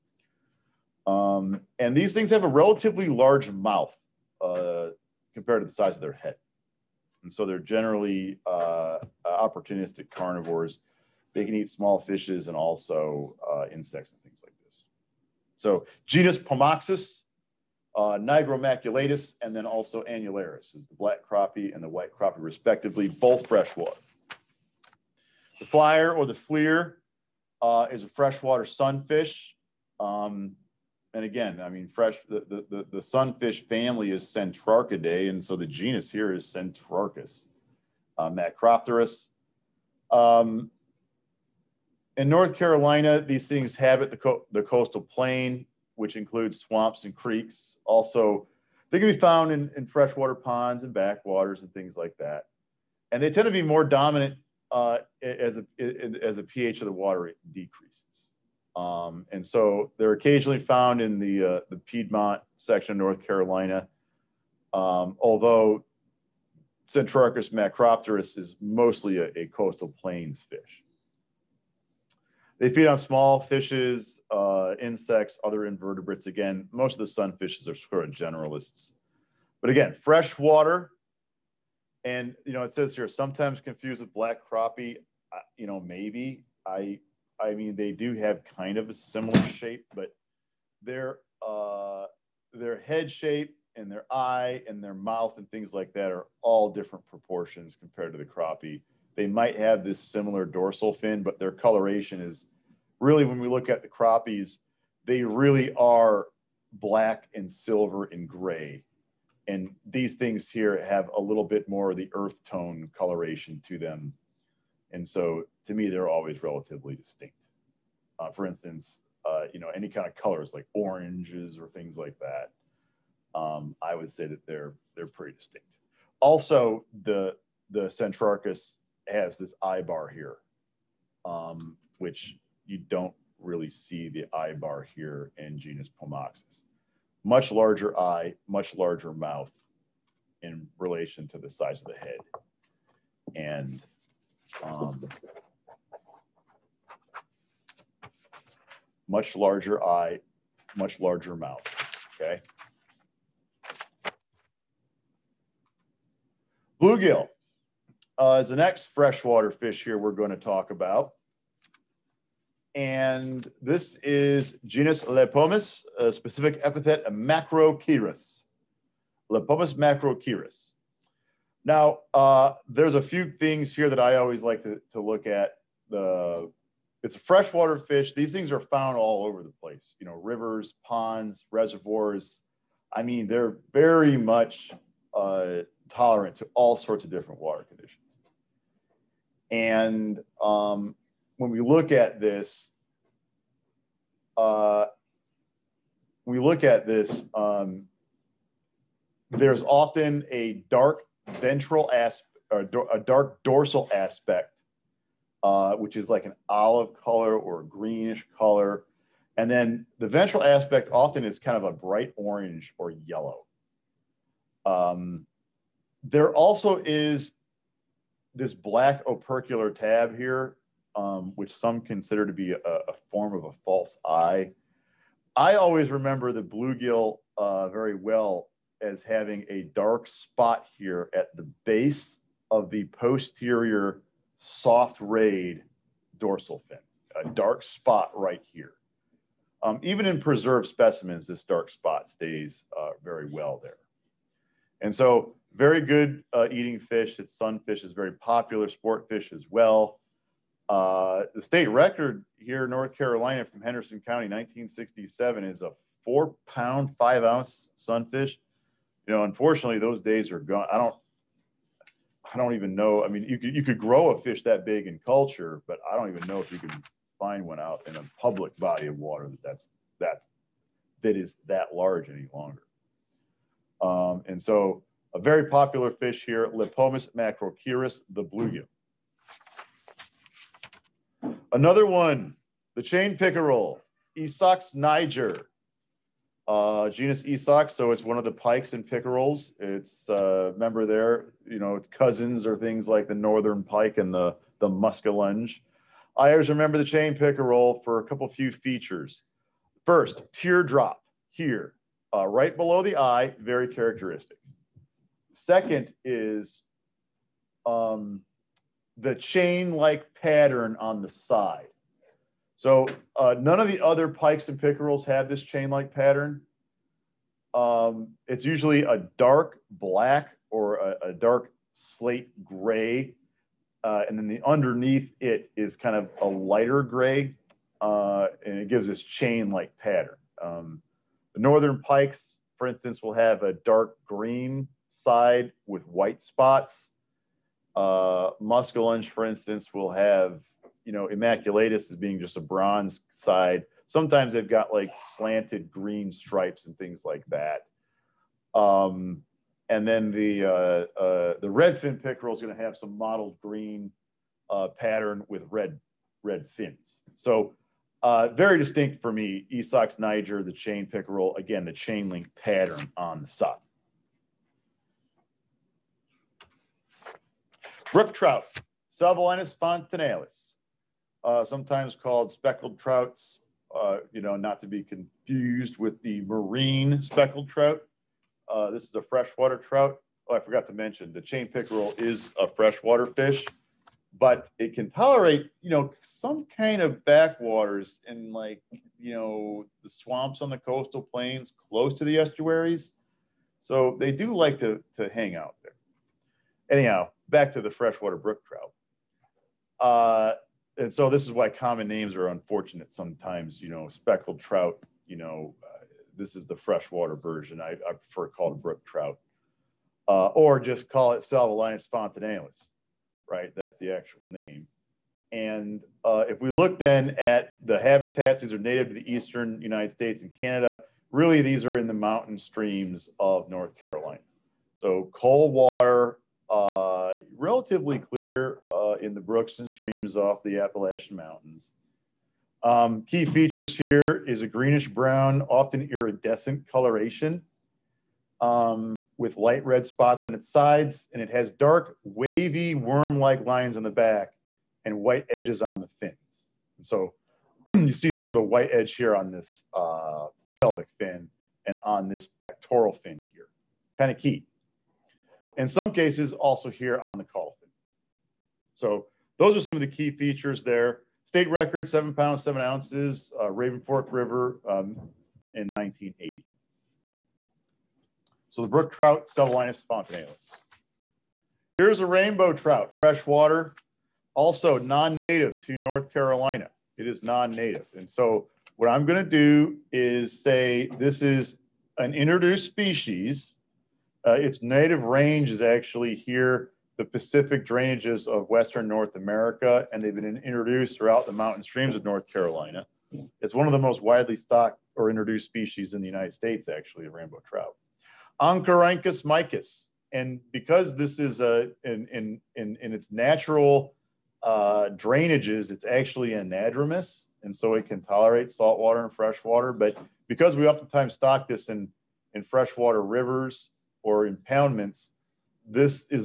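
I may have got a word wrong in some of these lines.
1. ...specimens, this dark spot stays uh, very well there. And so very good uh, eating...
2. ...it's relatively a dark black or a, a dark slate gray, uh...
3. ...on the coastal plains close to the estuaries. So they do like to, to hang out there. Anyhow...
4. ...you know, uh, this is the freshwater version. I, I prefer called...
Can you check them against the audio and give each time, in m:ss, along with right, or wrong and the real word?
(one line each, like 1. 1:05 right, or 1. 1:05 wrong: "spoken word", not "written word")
1. 4:00 right
2. 5:18 wrong: "usually", not "relatively"
3. 6:30 right
4. 6:45 right.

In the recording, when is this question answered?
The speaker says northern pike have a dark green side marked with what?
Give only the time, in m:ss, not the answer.
5:35.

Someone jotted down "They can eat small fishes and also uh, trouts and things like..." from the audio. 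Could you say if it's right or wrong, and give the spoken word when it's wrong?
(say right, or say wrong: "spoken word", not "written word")
wrong: "insects", not "trouts".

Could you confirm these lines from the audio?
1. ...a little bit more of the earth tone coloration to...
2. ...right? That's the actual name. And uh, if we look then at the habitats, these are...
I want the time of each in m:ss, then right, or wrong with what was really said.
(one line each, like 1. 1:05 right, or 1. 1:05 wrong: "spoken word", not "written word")
1. 1:51 right
2. 6:53 right.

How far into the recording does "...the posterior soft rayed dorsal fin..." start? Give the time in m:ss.
3:52.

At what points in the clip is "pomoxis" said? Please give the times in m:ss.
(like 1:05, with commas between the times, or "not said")
0:16, 2:16.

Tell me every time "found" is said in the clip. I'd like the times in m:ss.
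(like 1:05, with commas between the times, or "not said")
0:49, 1:00, 2:58.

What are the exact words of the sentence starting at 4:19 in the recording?
You know, unfortunately, those days are gone.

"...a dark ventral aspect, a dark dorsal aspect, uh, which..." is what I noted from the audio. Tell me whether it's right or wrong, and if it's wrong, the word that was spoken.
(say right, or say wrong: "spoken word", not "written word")
right.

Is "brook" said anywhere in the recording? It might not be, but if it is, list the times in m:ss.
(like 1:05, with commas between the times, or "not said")
6:07, 6:38, 6:48, 7:09, 7:48.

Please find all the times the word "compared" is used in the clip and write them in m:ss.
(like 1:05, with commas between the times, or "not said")
0:05, 1:37.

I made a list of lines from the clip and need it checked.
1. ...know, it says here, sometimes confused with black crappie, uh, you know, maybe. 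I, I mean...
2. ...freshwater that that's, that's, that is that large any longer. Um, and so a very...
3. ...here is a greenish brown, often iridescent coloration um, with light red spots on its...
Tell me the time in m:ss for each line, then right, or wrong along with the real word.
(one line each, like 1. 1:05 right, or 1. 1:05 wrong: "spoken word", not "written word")
1. 1:22 right
2. 4:28 wrong: "water", not "freshwater"
3. 7:13 right.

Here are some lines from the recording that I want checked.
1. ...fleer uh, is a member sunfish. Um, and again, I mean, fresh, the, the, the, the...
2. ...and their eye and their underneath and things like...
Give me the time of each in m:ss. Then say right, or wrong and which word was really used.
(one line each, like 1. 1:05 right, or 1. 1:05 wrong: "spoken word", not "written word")
1. 0:26 wrong: "freshwater", not "member"
2. 1:33 wrong: "mouth", not "underneath".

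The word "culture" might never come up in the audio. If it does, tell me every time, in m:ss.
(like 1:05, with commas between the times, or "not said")
4:25.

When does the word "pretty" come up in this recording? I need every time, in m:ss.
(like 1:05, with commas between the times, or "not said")
2:05.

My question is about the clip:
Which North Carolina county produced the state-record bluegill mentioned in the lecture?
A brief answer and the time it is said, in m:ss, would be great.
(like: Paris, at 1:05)
Henderson County, at 4:13.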